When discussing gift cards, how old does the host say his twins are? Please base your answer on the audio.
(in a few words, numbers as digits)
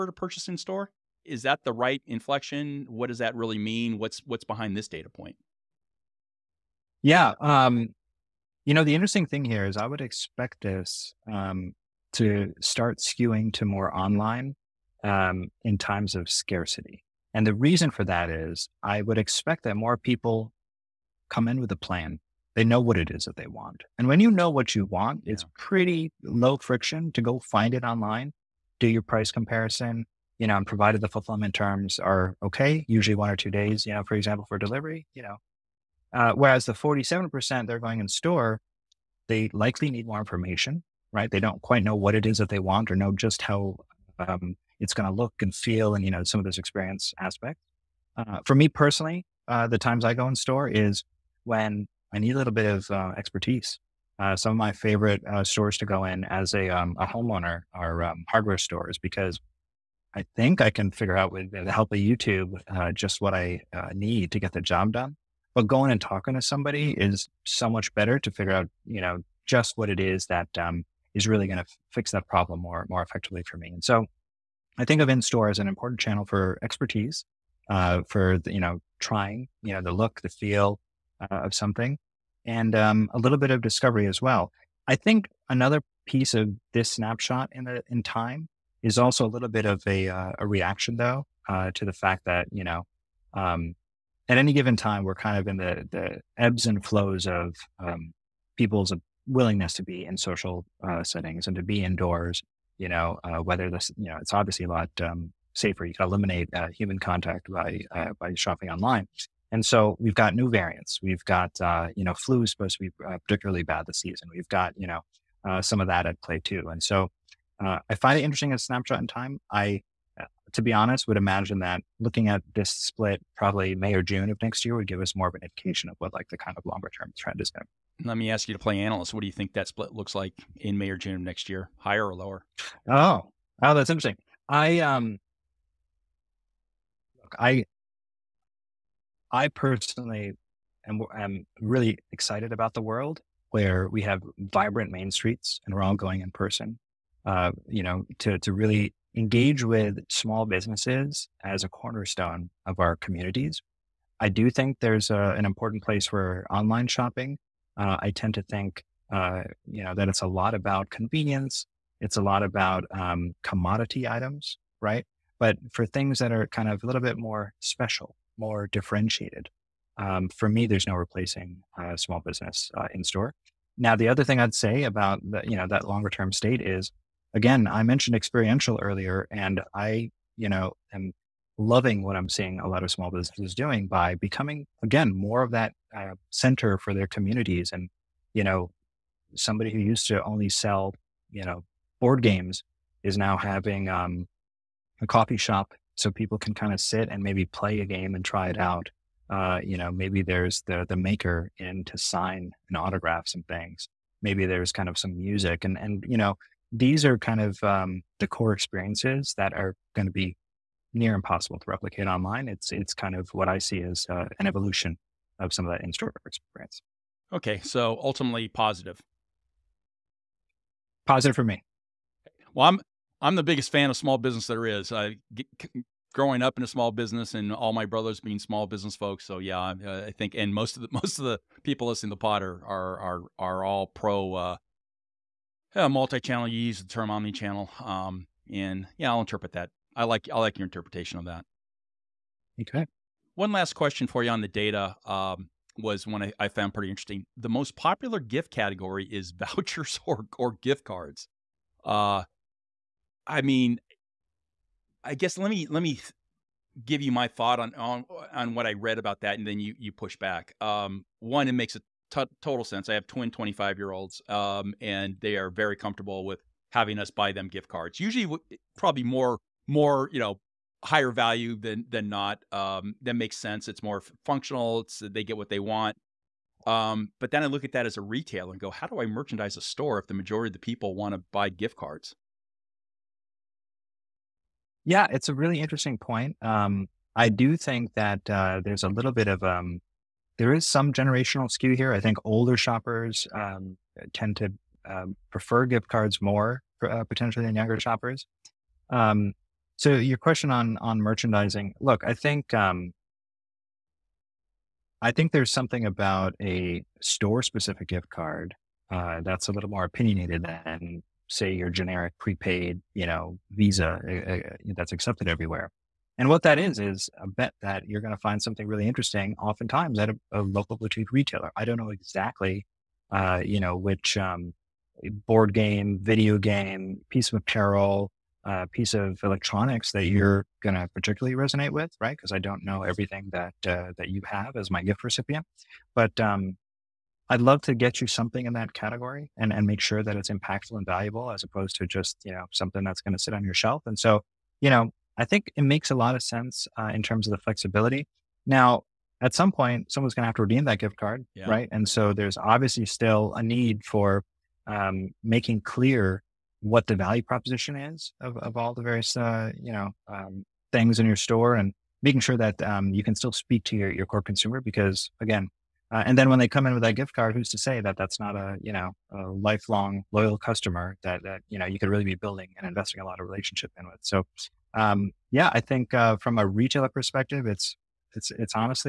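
25.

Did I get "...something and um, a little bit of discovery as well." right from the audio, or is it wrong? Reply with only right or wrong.
right.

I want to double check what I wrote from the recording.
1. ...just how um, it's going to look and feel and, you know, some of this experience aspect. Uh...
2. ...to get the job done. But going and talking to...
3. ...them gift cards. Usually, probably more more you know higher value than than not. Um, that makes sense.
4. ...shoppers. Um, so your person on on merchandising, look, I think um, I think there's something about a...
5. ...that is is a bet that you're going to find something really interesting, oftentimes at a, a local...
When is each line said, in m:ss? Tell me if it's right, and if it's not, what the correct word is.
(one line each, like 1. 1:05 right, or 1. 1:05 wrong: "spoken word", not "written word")
1. 0:43 right
2. 1:04 right
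3. 4:27 right
4. 4:57 wrong: "question", not "person"
5. 5:16 right.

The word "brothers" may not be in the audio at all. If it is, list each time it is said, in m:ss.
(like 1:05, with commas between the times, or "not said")
3:47.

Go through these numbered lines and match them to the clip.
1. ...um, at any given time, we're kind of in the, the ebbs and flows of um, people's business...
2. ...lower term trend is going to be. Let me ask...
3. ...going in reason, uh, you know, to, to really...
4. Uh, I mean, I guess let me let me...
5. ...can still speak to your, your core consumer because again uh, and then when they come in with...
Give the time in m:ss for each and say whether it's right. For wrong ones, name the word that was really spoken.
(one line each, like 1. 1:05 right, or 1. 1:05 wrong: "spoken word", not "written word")
1. 1:33 wrong: "willingness", not "business"
2. 2:06 wrong: "longer", not "lower"
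3. 2:25 wrong: "person", not "reason"
4. 4:11 right
5. 6:03 right.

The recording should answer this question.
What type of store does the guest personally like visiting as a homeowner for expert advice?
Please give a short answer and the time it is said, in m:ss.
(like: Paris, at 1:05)
Hardware stores, at 0:58.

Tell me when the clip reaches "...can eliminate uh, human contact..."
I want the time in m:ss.
1:45.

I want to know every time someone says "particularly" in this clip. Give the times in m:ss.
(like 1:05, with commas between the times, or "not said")
1:53, 5:30.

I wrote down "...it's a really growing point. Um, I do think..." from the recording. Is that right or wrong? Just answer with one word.
wrong.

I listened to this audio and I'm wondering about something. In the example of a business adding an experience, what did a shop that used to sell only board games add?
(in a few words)
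A coffee shop.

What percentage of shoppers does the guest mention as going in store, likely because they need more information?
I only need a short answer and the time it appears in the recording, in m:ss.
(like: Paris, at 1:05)
47%, at 0:36.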